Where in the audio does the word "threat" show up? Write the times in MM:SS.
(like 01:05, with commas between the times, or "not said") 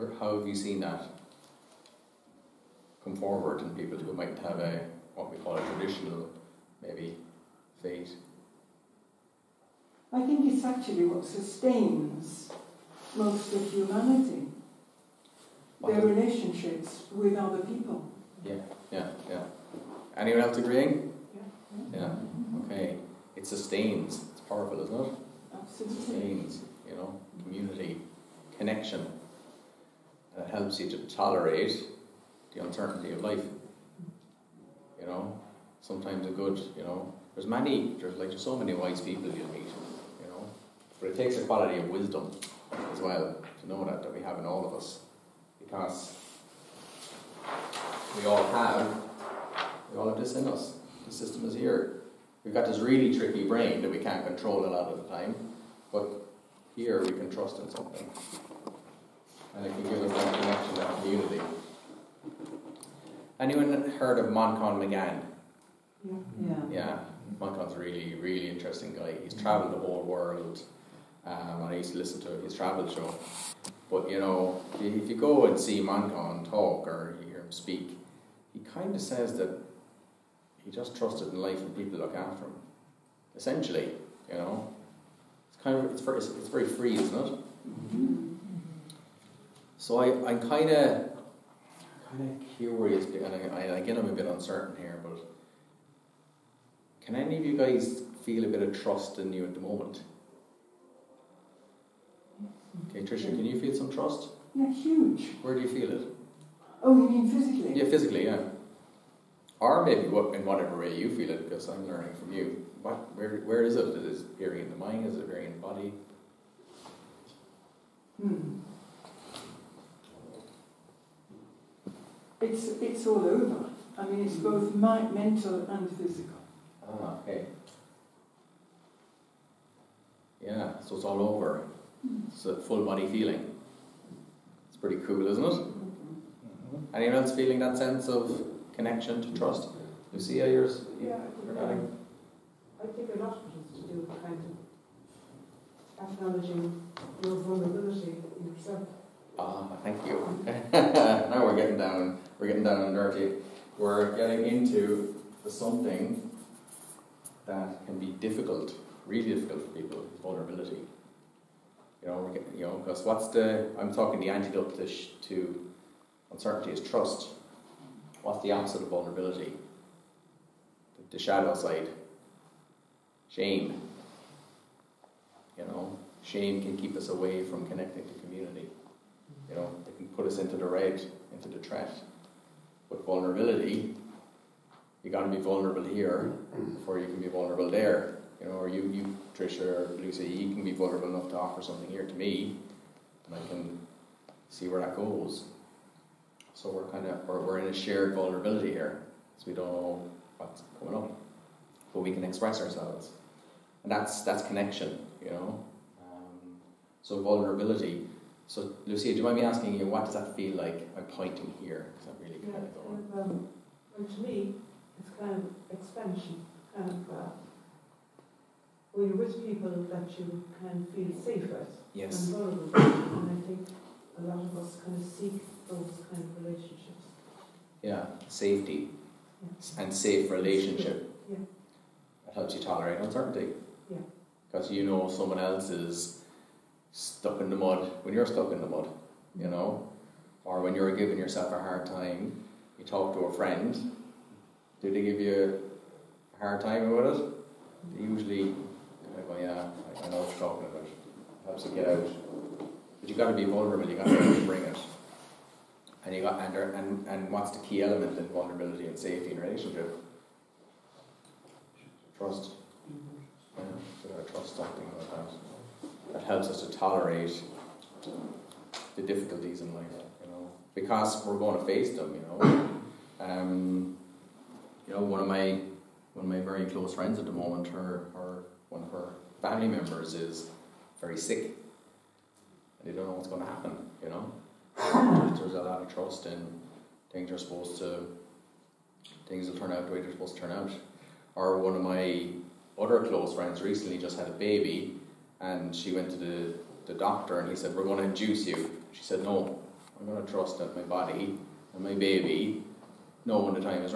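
03:01.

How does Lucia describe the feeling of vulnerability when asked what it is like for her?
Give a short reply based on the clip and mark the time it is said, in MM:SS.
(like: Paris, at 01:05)
Expansion, at 03:35.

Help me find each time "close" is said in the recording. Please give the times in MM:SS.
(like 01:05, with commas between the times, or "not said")
04:36, 04:52.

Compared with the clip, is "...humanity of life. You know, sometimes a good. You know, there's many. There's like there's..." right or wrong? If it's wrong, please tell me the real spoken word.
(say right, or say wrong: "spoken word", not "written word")
wrong: "uncertainty", not "humanity".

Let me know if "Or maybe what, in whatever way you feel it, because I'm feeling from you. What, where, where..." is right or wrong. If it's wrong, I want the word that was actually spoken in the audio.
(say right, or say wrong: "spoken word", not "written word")
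wrong: "learning", not "feeling".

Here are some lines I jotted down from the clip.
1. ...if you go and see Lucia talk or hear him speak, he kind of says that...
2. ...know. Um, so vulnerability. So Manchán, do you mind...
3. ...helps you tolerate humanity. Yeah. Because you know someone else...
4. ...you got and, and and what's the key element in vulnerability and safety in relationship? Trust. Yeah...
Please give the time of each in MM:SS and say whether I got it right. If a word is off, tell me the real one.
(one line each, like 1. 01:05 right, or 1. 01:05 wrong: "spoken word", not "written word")
1. 01:14 wrong: "Manchán", not "Lucia"
2. 03:25 wrong: "Lucia", not "Manchán"
3. 03:52 wrong: "uncertainty", not "humanity"
4. 04:16 right.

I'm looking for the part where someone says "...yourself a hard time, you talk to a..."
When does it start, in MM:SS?
04:01.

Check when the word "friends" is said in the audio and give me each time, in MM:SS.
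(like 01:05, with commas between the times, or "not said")
04:03, 04:36, 04:53.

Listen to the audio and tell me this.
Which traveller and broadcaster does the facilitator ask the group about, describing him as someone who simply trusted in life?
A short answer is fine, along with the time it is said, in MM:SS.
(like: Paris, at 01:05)
Manchán Magan, at 01:04.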